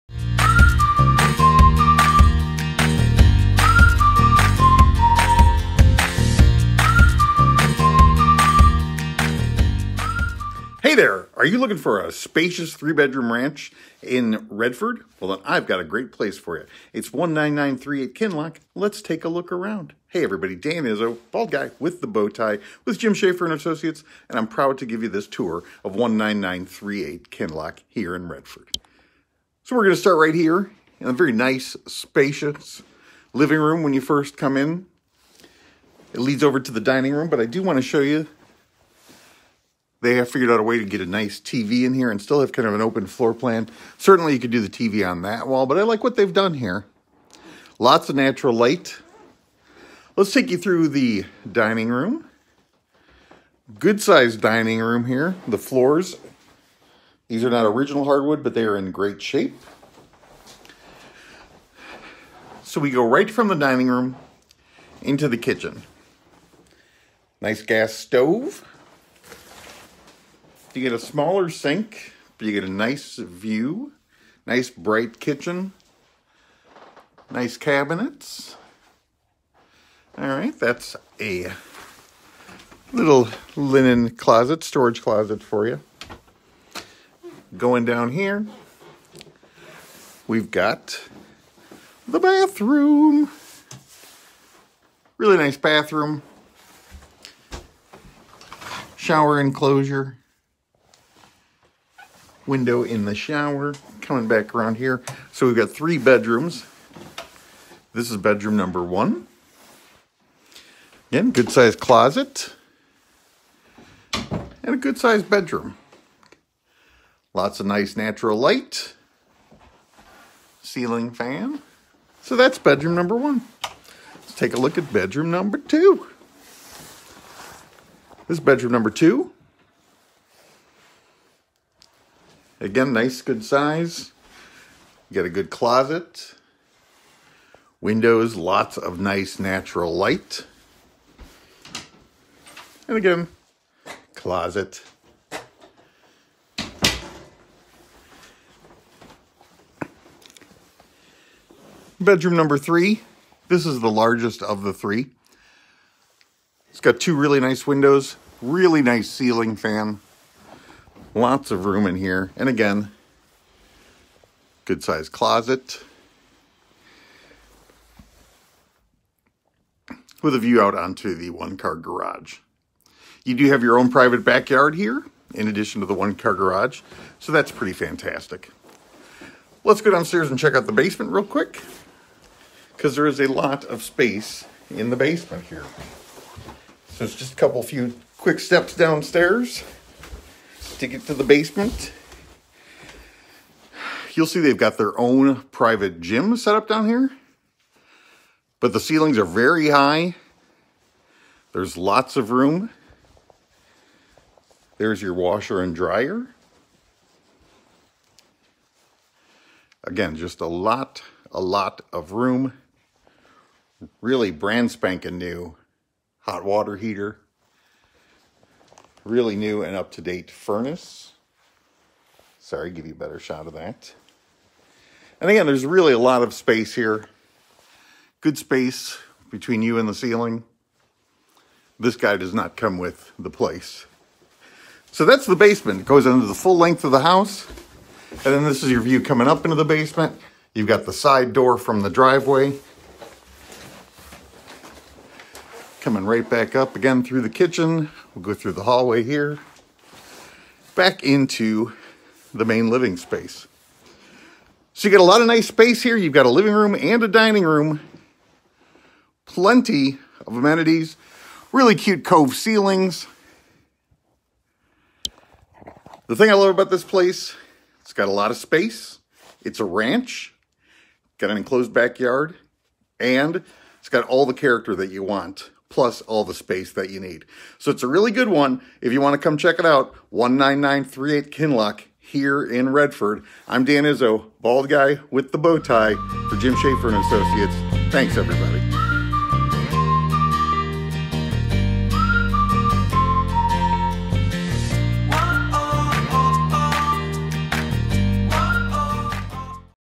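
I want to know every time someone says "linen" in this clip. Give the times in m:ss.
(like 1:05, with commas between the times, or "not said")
1:23.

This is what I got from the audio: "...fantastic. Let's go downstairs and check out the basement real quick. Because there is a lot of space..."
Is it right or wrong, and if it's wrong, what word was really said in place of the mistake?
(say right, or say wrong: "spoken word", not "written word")
right.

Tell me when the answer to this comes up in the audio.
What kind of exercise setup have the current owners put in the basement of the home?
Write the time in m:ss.
3:15.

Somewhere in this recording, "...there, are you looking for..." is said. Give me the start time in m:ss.
0:10.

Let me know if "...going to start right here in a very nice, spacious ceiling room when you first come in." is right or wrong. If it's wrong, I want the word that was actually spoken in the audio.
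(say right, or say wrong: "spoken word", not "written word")
wrong: "living", not "ceiling".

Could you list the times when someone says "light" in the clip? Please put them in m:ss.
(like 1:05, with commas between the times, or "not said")
0:48, 1:58, 2:19.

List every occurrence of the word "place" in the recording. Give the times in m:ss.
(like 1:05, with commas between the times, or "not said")
0:16, 3:53, 4:26.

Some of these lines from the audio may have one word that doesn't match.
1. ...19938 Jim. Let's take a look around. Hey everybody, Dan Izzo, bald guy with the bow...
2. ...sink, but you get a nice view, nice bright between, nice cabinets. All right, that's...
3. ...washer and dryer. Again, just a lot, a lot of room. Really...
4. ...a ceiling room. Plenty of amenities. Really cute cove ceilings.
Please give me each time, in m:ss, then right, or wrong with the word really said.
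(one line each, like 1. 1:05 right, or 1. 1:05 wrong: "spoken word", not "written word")
1. 0:17 wrong: "Kinloch", not "Jim"
2. 1:11 wrong: "kitchen", not "between"
3. 3:25 right
4. 4:17 wrong: "dining", not "ceiling".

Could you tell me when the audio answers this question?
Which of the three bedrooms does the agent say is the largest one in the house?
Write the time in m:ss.
2:31.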